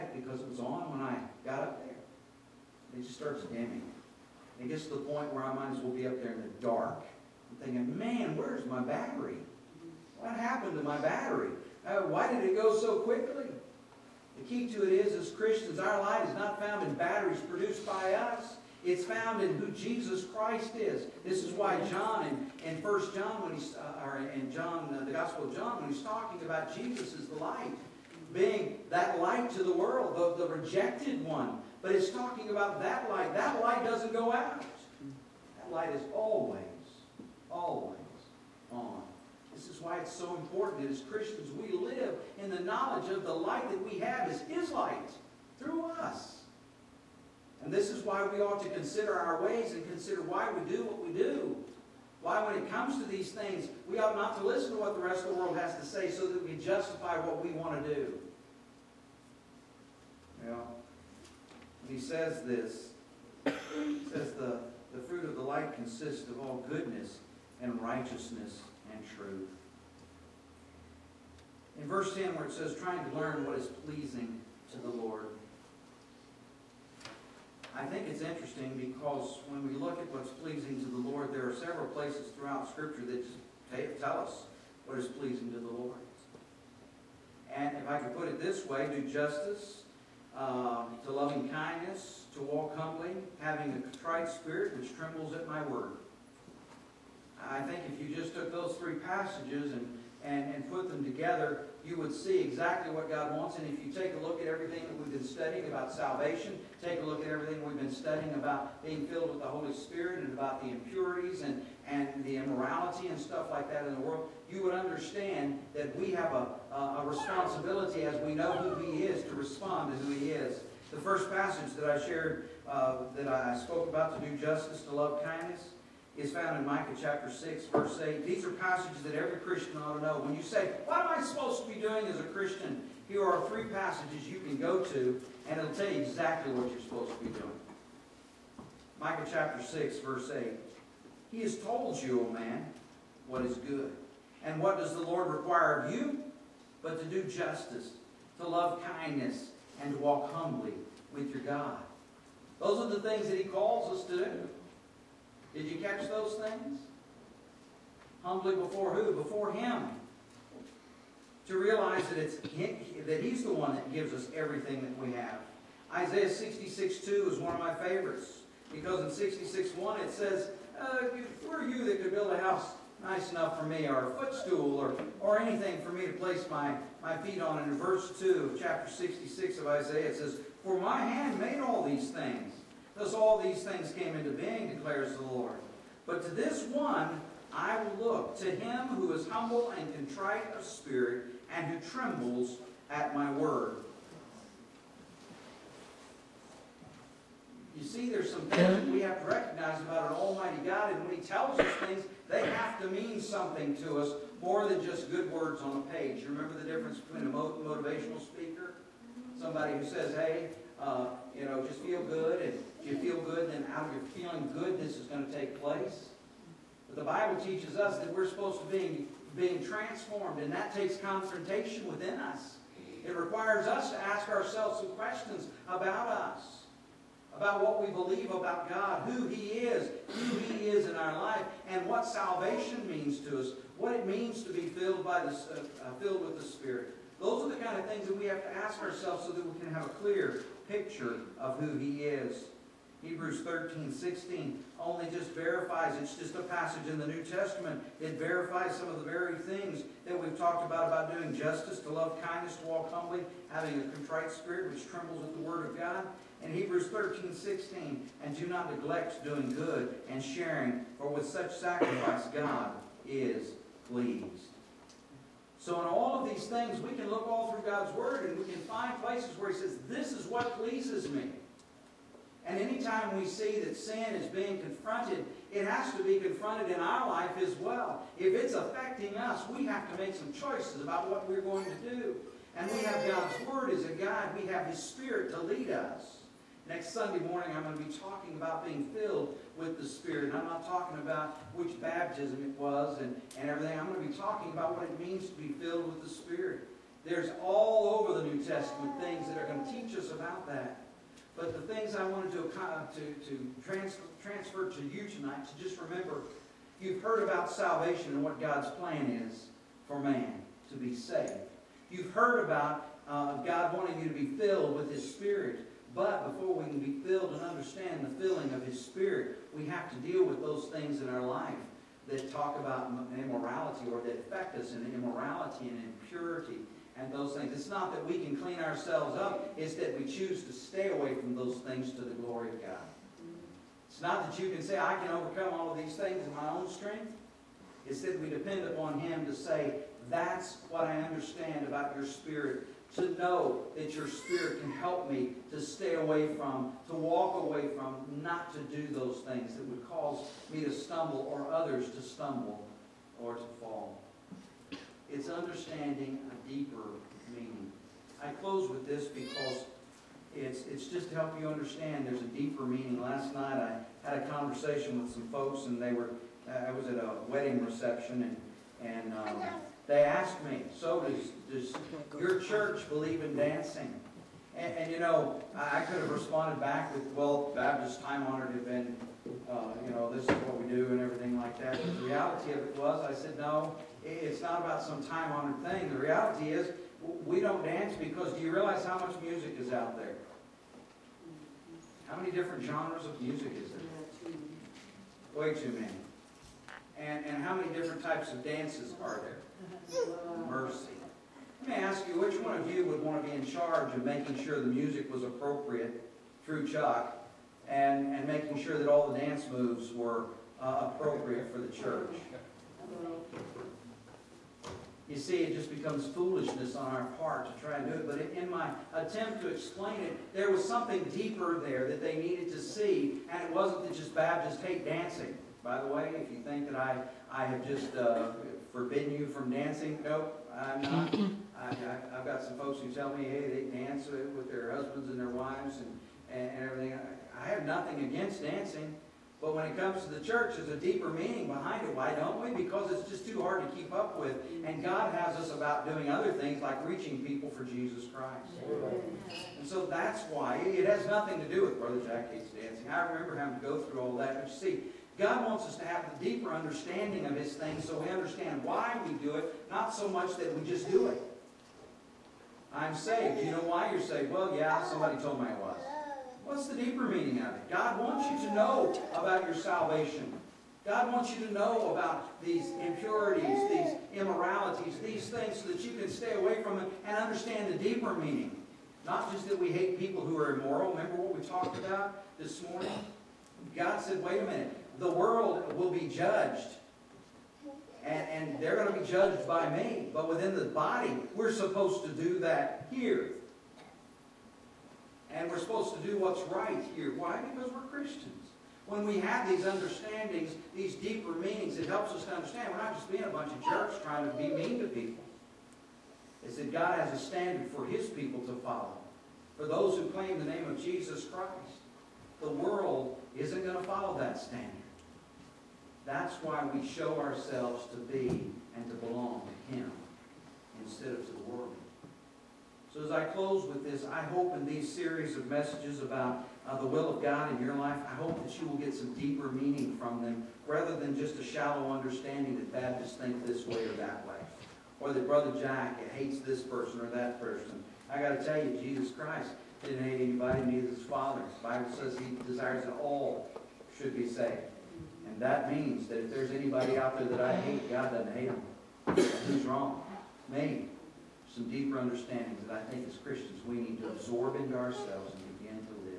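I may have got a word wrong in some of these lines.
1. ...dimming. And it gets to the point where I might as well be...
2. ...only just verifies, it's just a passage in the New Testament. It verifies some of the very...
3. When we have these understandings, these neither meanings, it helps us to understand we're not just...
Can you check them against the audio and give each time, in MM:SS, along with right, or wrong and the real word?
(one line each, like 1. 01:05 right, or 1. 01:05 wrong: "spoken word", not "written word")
1. 00:03 right
2. 04:04 right
3. 08:18 wrong: "deeper", not "neither".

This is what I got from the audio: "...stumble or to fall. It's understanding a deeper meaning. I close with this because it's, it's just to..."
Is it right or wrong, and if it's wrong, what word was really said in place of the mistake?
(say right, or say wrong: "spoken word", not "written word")
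right.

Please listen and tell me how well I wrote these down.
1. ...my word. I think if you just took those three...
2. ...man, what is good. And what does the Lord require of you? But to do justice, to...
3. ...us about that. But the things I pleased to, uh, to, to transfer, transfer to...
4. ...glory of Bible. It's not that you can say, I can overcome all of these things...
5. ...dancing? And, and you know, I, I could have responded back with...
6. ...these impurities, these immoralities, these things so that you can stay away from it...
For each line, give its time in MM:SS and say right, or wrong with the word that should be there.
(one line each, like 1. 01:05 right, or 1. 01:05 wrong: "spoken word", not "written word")
1. 01:35 right
2. 02:22 right
3. 04:59 wrong: "wanted", not "pleased"
4. 05:32 wrong: "God", not "Bible"
5. 06:13 right
6. 07:52 right.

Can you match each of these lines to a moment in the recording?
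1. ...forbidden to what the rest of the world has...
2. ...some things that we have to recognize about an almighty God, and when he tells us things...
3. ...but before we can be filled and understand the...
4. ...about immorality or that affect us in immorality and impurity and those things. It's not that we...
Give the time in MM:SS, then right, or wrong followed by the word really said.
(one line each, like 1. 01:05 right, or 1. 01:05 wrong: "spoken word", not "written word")
1. 00:54 wrong: "listen", not "forbidden"
2. 03:18 right
3. 05:15 right
4. 05:22 right.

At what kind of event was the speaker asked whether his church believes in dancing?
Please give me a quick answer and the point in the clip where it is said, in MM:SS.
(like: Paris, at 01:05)
wedding reception, at 06:07.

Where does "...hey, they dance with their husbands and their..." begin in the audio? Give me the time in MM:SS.
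07:13.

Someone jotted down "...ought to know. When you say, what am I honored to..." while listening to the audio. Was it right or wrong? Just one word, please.
wrong.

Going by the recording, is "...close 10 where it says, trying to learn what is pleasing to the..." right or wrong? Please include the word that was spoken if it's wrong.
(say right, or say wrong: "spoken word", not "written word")
wrong: "verse", not "close".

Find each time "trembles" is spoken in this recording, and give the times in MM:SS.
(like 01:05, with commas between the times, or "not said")
01:34, 03:11, 04:14.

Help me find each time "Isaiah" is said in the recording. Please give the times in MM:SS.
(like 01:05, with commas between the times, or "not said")
02:45, 02:59.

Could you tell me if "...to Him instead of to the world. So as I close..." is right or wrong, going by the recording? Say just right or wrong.
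right.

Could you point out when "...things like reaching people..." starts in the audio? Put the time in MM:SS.
07:26.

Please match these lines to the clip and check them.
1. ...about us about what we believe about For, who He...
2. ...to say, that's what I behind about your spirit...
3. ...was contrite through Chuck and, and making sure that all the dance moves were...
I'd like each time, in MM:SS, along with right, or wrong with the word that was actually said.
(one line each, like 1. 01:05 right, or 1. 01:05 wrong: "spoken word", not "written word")
1. 03:45 wrong: "God", not "For"
2. 05:39 wrong: "understand", not "behind"
3. 06:45 wrong: "appropriate", not "contrite".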